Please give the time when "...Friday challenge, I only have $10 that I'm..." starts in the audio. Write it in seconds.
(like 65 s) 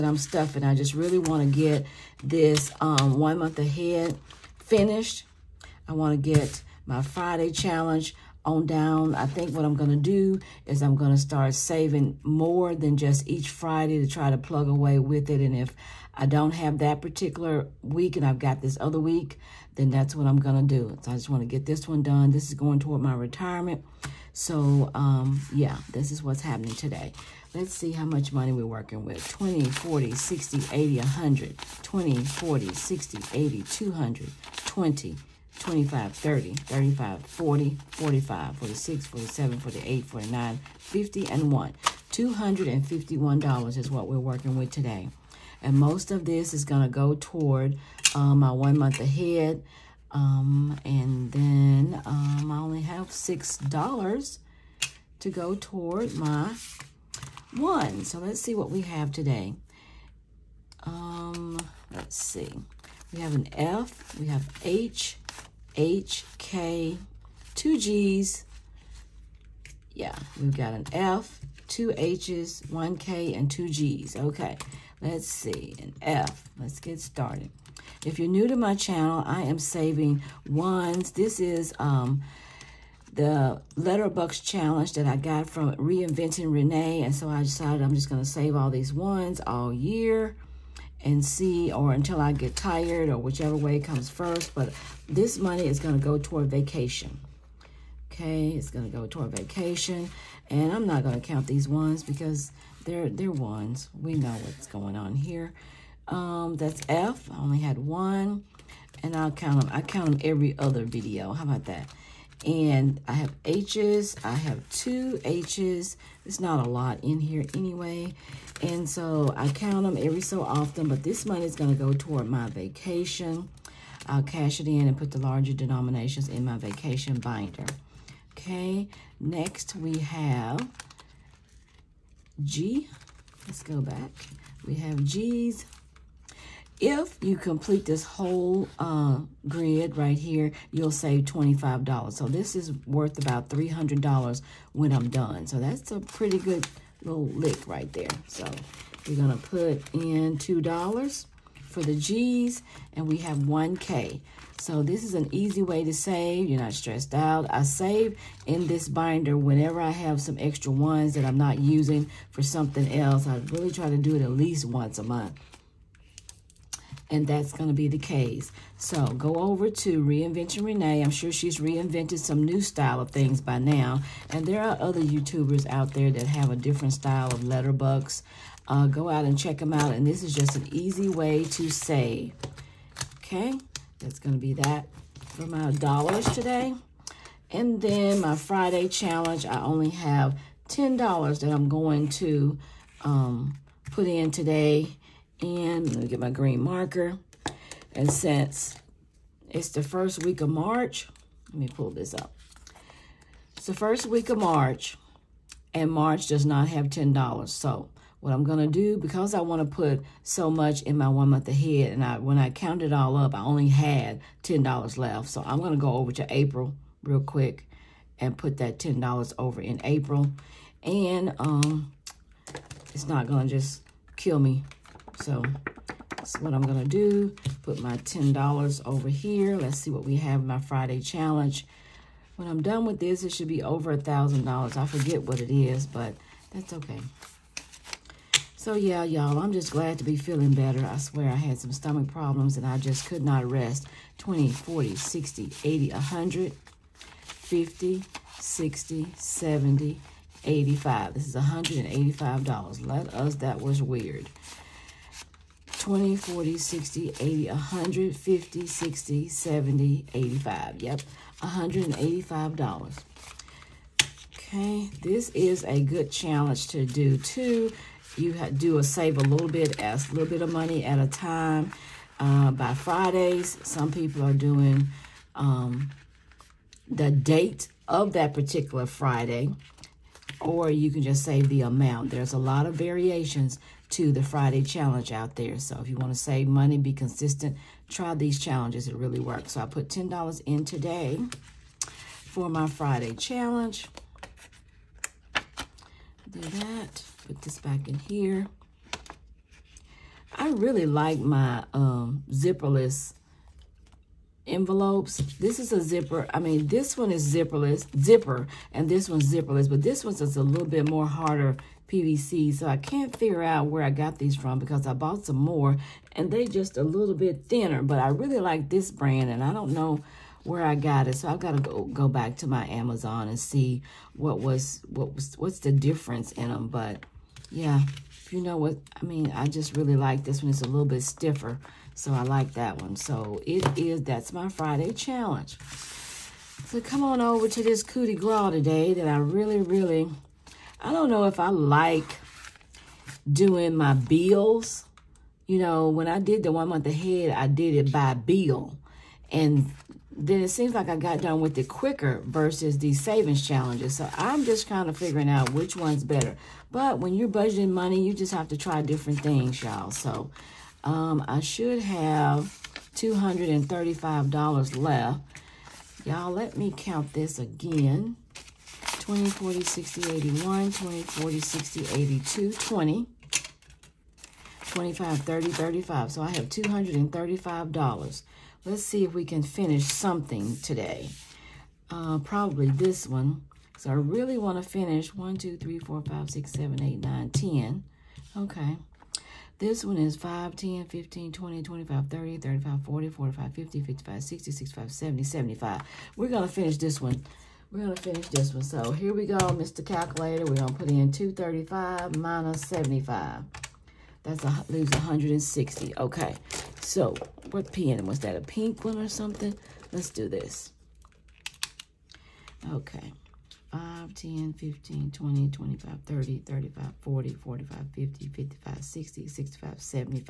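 188 s.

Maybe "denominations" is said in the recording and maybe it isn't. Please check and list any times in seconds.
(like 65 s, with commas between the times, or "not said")
125 s.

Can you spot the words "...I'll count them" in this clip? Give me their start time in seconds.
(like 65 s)
109 s.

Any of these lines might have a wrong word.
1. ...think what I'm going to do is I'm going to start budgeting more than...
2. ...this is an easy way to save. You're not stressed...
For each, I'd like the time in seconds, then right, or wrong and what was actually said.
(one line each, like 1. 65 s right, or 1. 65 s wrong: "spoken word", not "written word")
1. 9 s wrong: "saving", not "budgeting"
2. 154 s right.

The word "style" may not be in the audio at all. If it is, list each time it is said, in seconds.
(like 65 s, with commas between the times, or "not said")
172 s, 176 s.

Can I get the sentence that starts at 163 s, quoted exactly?
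I really try to do it at least once a month and that's going to be the case.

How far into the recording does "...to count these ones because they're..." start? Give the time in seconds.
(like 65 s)
101 s.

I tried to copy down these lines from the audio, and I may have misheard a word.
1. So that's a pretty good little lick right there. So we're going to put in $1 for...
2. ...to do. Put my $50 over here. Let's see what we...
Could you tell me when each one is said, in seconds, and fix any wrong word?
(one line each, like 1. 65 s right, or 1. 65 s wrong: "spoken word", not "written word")
1. 145 s wrong: "2", not "1"
2. 226 s wrong: "10", not "50".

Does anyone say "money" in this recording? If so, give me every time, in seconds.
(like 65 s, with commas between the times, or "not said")
28 s, 95 s, 121 s, 270 s, 286 s, 357 s.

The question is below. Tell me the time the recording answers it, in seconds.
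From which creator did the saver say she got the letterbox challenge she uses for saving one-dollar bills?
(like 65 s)
85 s.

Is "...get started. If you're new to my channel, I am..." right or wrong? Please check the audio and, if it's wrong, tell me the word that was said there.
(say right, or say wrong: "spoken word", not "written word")
right.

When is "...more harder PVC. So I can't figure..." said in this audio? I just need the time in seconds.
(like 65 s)
310 s.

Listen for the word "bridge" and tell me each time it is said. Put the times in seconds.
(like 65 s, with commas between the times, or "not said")
not said.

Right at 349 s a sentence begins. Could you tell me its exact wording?
And then it seems like I got done with it quicker versus these savings challenges.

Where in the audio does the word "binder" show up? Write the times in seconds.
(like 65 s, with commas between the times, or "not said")
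127 s, 158 s.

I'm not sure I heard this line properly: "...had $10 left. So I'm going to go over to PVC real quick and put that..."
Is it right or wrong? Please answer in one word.
wrong.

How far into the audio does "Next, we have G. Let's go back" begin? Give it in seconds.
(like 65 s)
129 s.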